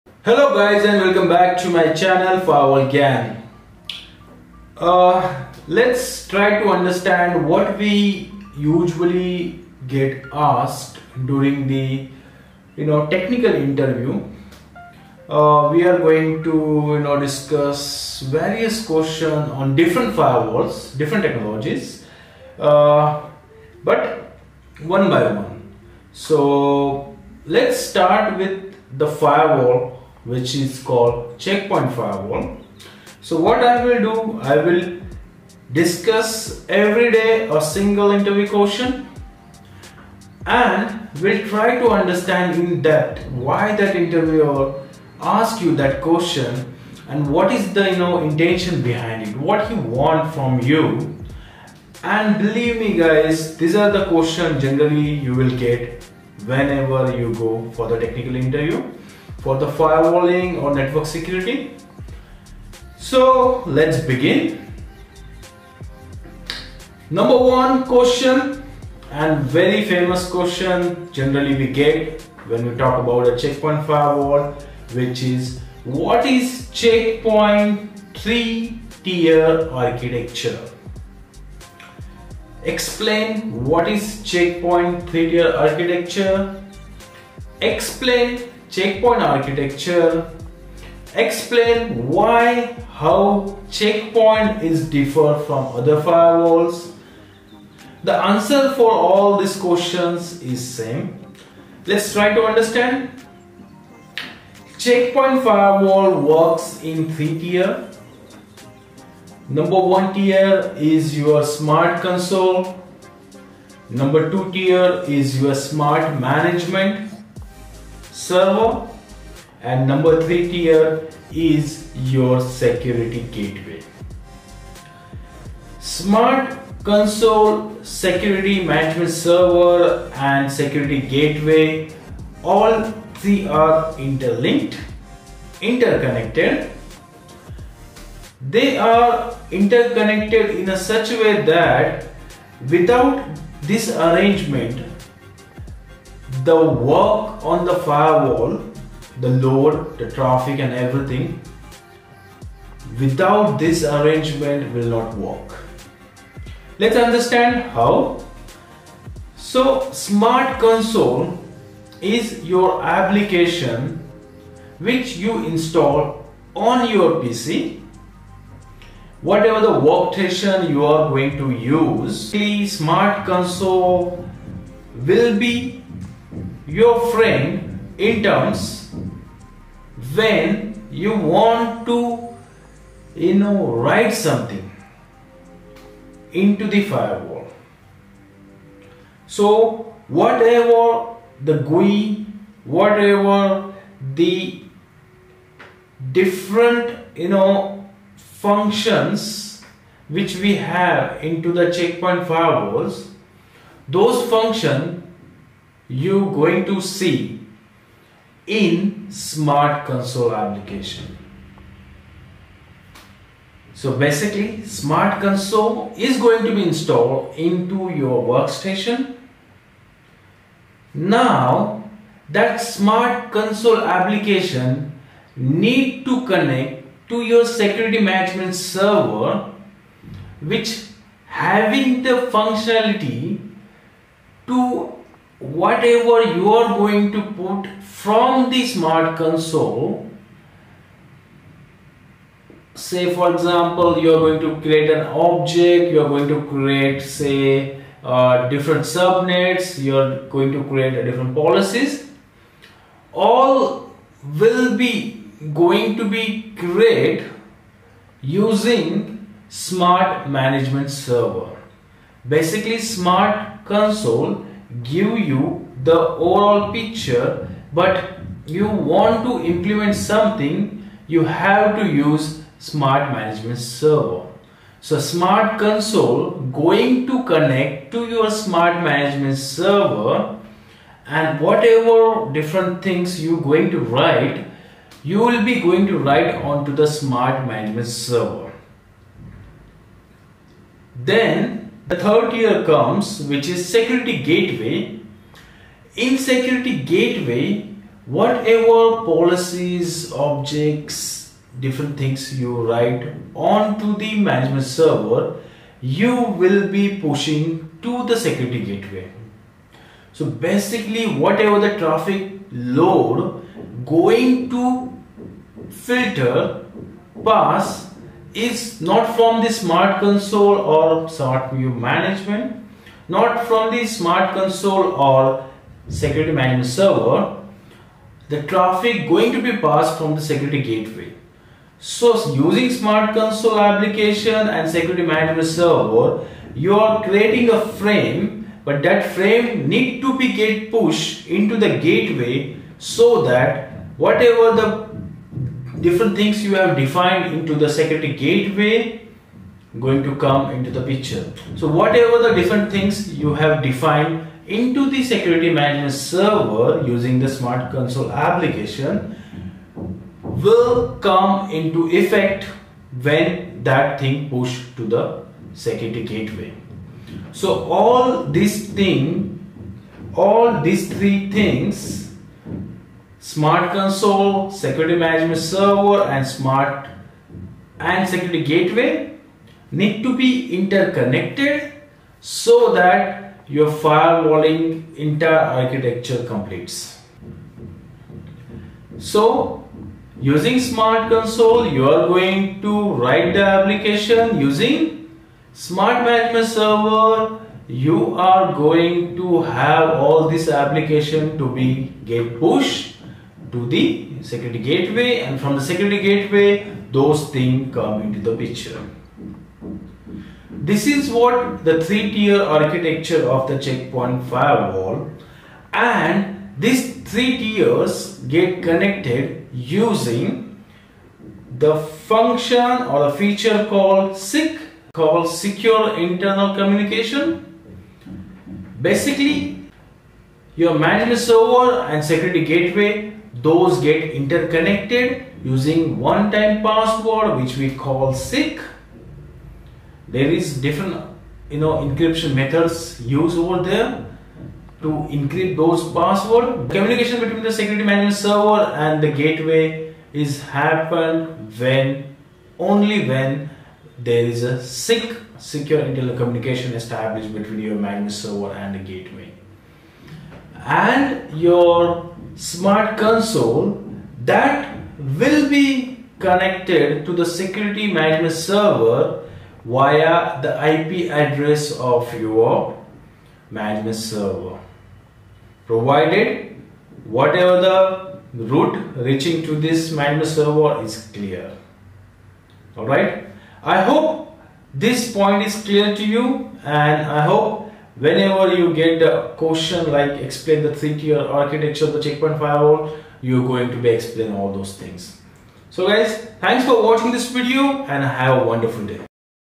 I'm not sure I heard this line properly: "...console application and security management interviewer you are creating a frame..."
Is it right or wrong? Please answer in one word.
wrong.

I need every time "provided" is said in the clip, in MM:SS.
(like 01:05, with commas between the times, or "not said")
07:55.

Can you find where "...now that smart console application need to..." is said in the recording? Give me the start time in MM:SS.
03:40.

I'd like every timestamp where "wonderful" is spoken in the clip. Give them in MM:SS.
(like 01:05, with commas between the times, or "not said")
08:18.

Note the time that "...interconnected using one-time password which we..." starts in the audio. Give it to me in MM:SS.
07:14.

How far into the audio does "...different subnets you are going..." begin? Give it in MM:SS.
04:08.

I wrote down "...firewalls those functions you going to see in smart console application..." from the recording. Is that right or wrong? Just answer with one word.
right.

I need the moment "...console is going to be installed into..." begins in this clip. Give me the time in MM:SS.
03:35.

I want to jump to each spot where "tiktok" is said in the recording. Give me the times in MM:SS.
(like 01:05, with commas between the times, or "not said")
not said.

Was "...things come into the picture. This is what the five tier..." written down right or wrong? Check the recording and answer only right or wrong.
wrong.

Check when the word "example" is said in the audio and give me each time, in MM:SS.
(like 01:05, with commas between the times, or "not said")
04:03.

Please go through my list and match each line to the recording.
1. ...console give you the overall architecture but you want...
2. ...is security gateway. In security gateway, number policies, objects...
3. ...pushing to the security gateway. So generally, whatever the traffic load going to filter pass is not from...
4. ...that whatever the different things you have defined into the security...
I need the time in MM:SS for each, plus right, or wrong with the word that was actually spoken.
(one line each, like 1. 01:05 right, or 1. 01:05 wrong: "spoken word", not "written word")
1. 04:23 wrong: "picture", not "architecture"
2. 04:53 wrong: "whatever", not "number"
3. 05:07 wrong: "basically", not "generally"
4. 05:43 right.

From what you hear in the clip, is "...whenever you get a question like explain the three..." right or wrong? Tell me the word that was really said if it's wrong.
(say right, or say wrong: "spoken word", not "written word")
right.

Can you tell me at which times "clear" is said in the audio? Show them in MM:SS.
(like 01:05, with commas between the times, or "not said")
08:01, 08:05.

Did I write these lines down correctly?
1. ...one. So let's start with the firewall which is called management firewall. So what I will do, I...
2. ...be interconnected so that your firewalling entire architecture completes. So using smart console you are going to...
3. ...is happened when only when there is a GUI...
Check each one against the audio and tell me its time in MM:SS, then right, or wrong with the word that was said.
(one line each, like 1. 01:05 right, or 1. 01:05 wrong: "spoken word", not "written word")
1. 00:25 wrong: "checkpoint", not "management"
2. 06:20 right
3. 07:30 wrong: "SIC", not "GUI".